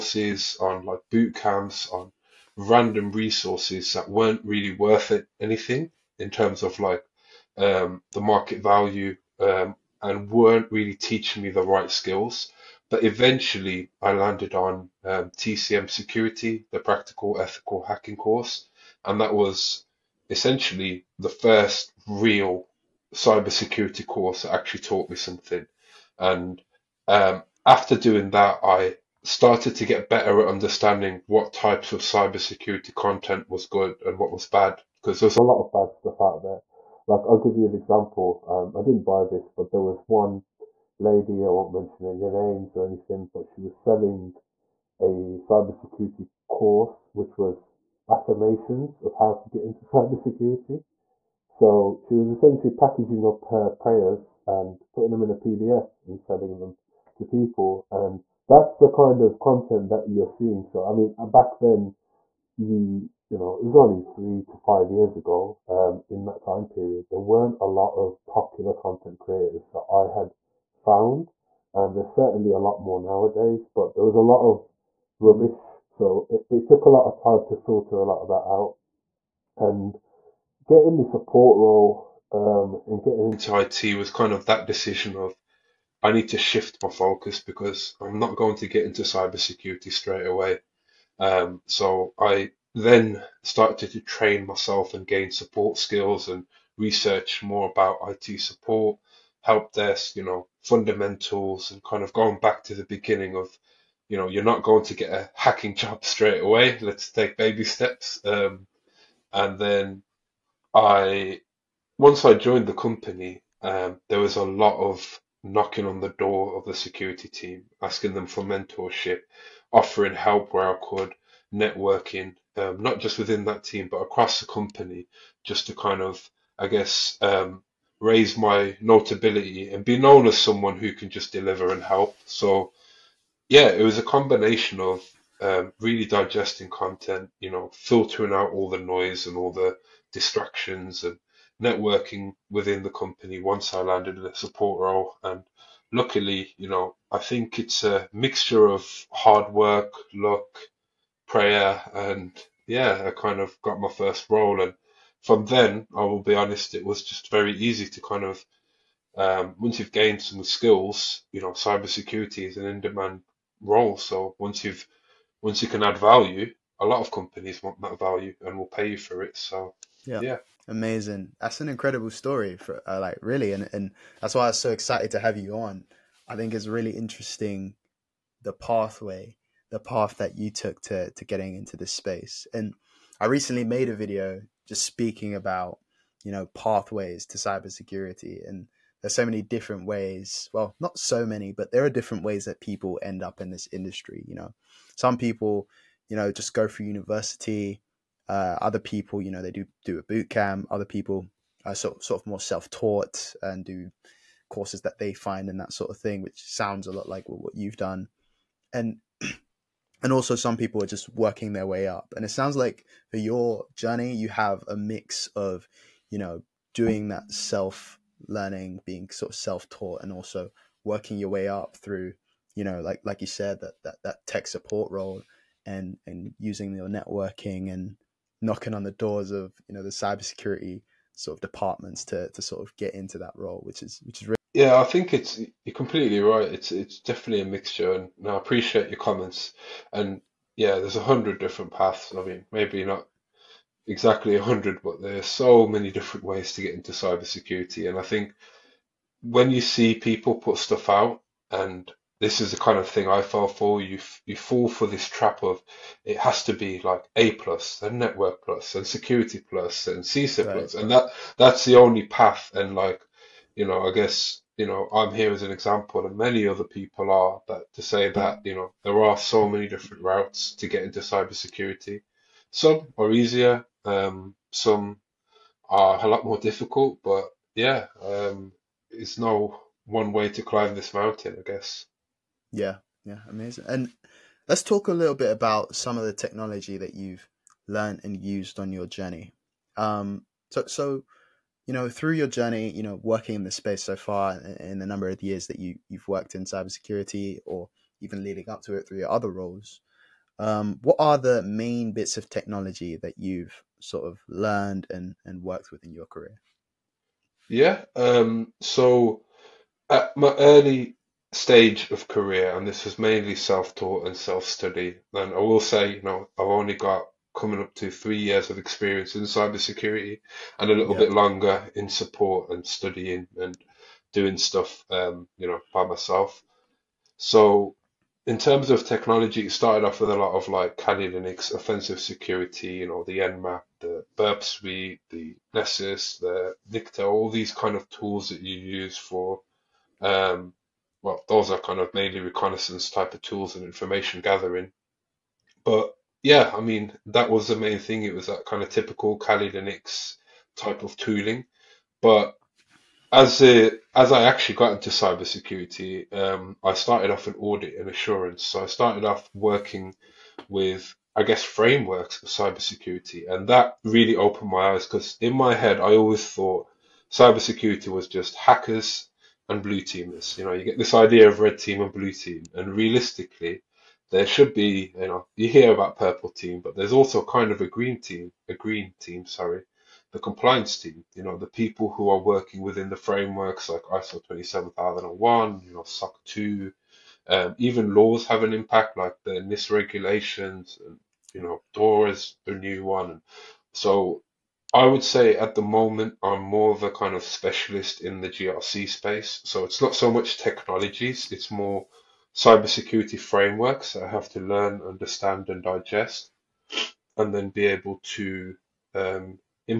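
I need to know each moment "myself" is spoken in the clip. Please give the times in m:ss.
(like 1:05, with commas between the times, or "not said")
1:34, 5:25.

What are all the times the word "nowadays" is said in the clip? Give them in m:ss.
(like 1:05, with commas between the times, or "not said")
1:12.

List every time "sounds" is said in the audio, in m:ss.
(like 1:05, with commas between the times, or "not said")
3:26, 3:32.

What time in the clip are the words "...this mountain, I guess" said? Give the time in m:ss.
4:40.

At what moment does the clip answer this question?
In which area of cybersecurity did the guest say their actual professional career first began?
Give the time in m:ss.
5:57.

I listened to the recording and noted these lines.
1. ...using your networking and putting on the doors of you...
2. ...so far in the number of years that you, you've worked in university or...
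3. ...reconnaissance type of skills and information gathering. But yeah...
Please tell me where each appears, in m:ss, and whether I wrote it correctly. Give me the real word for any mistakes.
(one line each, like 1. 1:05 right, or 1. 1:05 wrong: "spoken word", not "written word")
1. 3:46 wrong: "knocking", not "putting"
2. 4:53 wrong: "cybersecurity", not "university"
3. 5:42 wrong: "tools", not "skills".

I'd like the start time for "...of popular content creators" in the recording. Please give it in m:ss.
1:07.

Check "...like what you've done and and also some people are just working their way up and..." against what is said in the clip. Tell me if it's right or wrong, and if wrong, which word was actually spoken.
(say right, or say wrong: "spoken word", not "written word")
right.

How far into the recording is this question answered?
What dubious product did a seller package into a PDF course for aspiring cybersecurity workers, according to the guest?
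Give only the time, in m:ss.
0:48.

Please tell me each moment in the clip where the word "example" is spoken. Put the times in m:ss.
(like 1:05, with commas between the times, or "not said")
0:37, 4:25.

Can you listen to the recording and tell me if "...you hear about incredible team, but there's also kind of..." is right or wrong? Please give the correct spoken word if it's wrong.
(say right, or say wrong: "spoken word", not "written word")
wrong: "purple", not "incredible".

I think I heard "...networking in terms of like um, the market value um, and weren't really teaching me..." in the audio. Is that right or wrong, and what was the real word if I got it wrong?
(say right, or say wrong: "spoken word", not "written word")
wrong: "anything", not "networking".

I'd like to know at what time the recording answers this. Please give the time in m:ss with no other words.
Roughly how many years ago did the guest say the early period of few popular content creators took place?
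1:04.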